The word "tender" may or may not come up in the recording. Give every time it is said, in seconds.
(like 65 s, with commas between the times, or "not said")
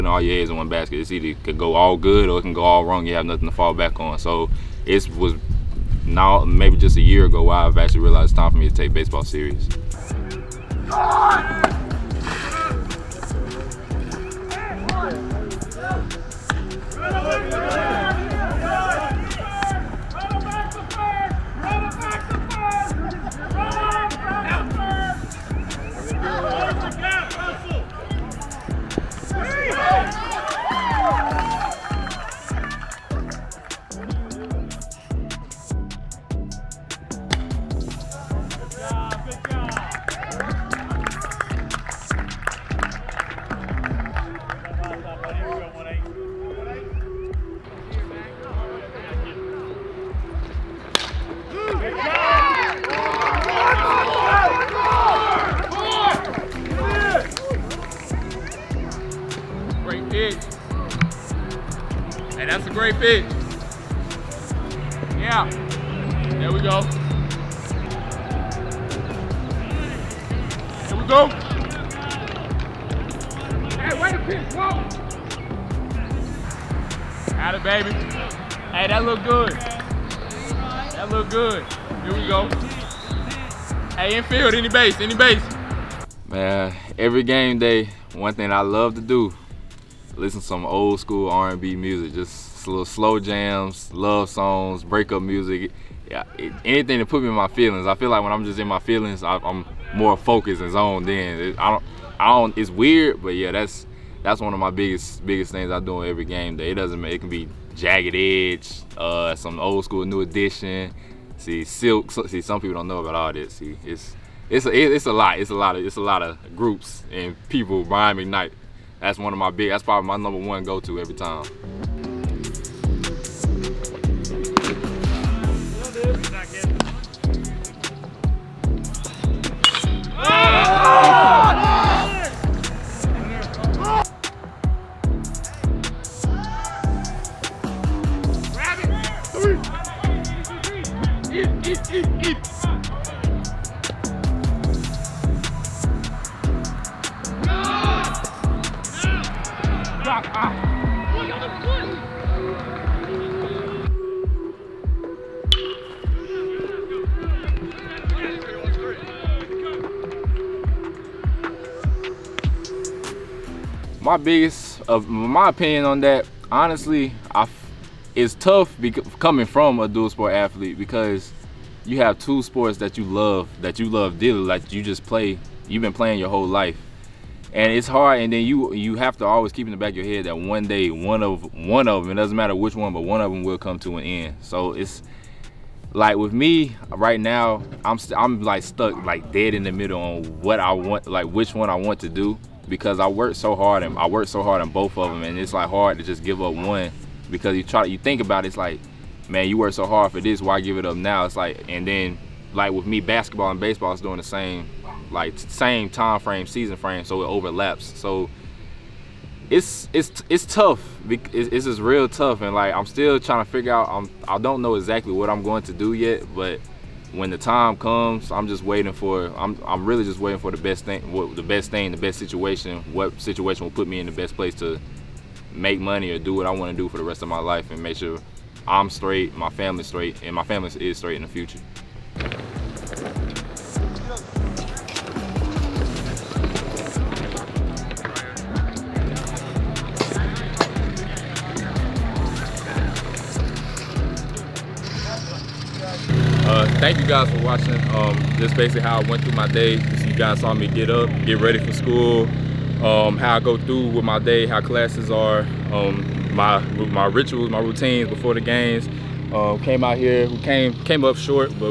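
not said.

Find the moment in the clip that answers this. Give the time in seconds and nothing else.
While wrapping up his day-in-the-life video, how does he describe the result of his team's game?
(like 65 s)
260 s.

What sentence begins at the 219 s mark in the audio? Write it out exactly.
I'm I'm really just waiting for the best thing, what, the best thing, the best situation.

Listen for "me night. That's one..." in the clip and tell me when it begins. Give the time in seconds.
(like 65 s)
118 s.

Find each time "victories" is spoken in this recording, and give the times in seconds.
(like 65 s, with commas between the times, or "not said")
not said.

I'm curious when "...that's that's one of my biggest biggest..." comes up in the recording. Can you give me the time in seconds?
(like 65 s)
103 s.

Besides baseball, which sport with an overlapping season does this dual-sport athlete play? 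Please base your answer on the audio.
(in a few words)
basketball.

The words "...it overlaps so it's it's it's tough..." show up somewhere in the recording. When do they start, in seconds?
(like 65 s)
207 s.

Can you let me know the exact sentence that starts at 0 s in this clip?
It's either it could go all good or it can go all wrong.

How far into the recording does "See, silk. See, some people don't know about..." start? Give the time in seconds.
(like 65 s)
111 s.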